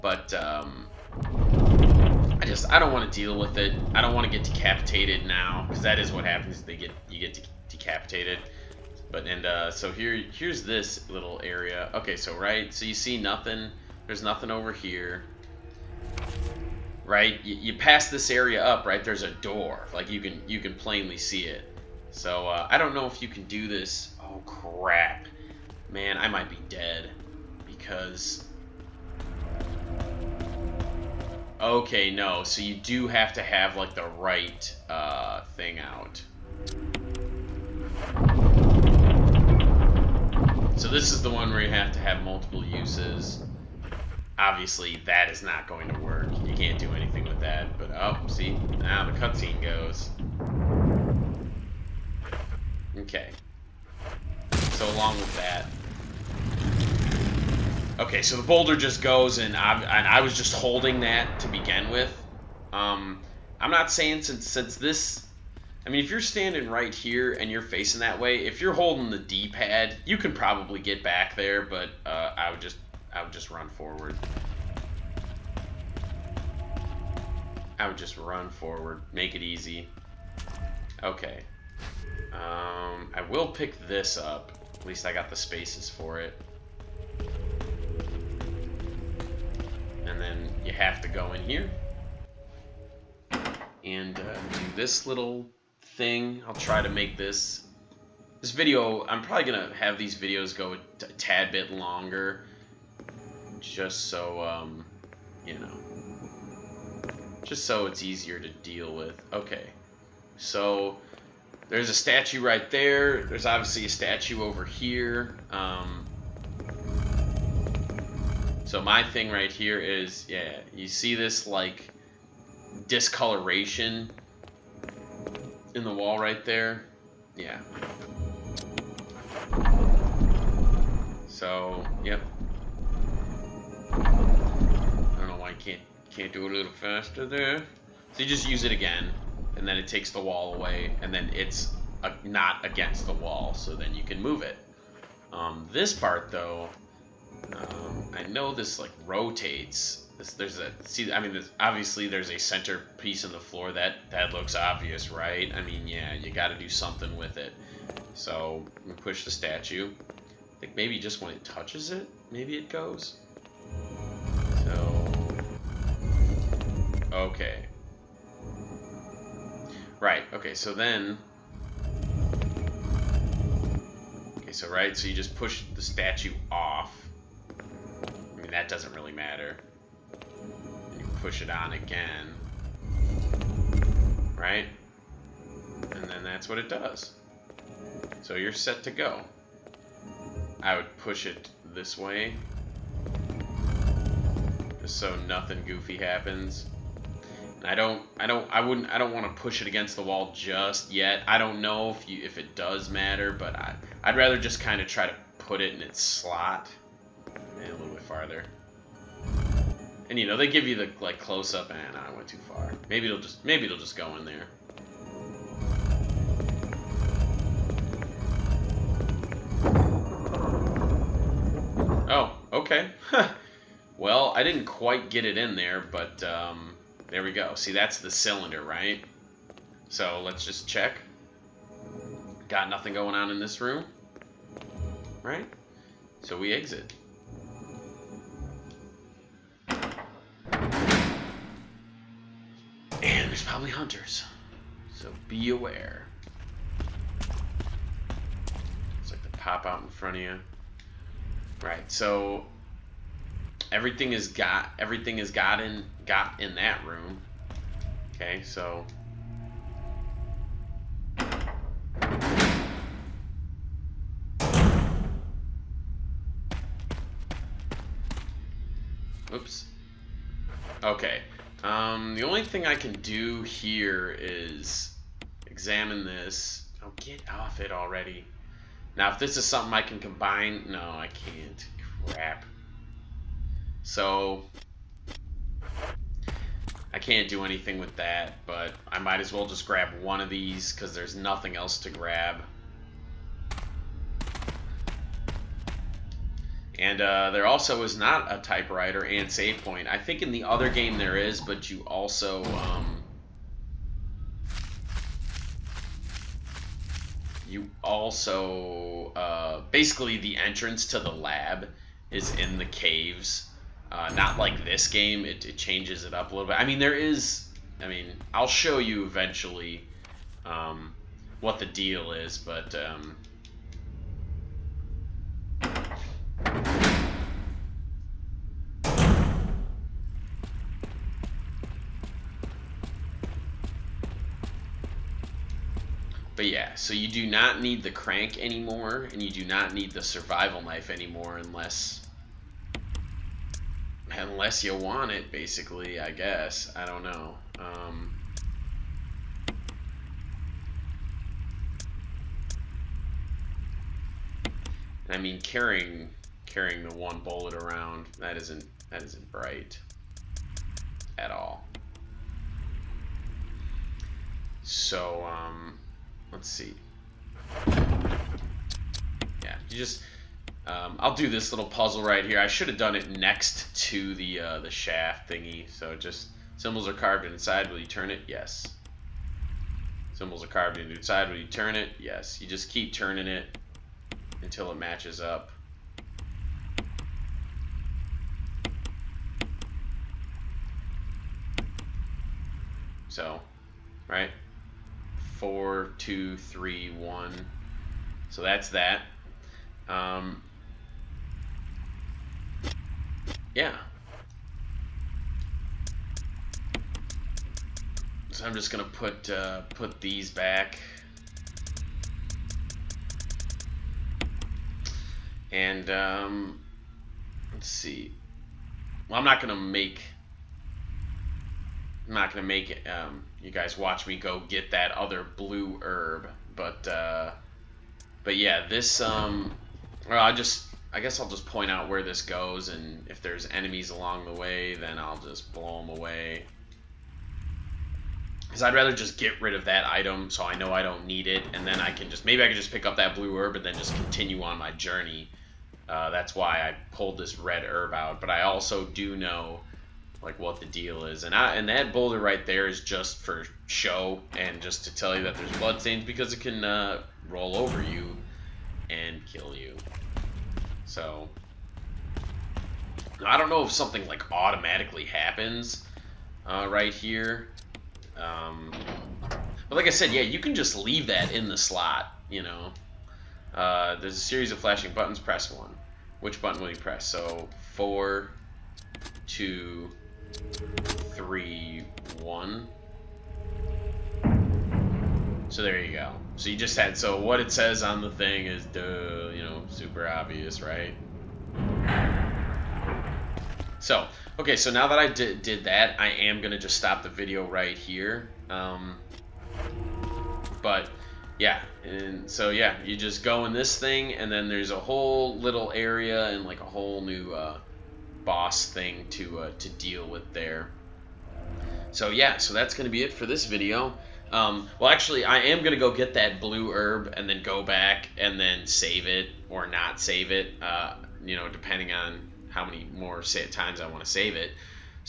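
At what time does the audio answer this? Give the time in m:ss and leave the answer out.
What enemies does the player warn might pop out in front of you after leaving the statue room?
4:03.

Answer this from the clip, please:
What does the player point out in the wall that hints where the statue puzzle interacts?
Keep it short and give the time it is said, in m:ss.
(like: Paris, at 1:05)
Discoloration, at 2:02.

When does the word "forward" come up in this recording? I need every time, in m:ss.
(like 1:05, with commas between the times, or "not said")
1:13, 1:18.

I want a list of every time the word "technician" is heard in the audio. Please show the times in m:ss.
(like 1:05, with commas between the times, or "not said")
not said.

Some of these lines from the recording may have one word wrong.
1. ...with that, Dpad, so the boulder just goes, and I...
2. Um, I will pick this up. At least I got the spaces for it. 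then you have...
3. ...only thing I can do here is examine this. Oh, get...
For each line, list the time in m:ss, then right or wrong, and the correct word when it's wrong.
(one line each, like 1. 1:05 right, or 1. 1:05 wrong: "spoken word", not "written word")
1. 0:55 wrong: "Okay", not "Dpad"
2. 1:22 right
3. 4:32 right.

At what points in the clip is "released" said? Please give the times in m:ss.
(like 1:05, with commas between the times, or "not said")
not said.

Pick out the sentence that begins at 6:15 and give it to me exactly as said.
So just symbols are carved inside.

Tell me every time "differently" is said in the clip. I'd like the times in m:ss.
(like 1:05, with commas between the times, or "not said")
not said.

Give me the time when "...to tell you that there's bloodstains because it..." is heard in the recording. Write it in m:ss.
7:34.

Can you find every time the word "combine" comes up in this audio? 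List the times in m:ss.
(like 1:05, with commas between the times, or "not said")
4:39.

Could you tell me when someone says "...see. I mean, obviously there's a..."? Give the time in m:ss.
2:30.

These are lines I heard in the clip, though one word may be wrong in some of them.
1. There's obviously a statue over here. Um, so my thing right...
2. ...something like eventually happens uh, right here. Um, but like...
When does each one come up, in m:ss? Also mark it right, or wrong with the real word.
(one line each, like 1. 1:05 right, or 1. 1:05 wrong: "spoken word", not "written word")
1. 1:53 right
2. 7:43 wrong: "automatically", not "eventually".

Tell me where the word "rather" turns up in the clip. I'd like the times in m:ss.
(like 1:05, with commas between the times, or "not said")
3:24, 7:18.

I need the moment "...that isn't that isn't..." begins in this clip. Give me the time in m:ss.
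5:58.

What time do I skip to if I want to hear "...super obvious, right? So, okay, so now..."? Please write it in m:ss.
8:09.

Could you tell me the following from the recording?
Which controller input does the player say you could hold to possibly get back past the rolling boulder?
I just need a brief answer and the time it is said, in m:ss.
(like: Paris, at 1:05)
D-pad, at 1:09.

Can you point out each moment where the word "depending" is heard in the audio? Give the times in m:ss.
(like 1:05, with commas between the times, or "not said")
8:41.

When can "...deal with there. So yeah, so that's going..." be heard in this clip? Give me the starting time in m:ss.
8:29.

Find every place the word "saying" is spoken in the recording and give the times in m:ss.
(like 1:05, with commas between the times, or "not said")
1:03.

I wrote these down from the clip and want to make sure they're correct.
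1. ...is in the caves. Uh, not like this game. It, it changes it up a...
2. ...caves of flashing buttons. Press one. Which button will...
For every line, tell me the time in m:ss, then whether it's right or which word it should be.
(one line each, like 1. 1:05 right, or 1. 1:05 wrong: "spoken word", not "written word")
1. 5:12 right
2. 7:54 wrong: "series", not "caves".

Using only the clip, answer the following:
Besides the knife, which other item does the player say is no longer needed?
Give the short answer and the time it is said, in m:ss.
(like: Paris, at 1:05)
Crank, at 5:37.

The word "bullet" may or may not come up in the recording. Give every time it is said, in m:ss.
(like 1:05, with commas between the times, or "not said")
5:57.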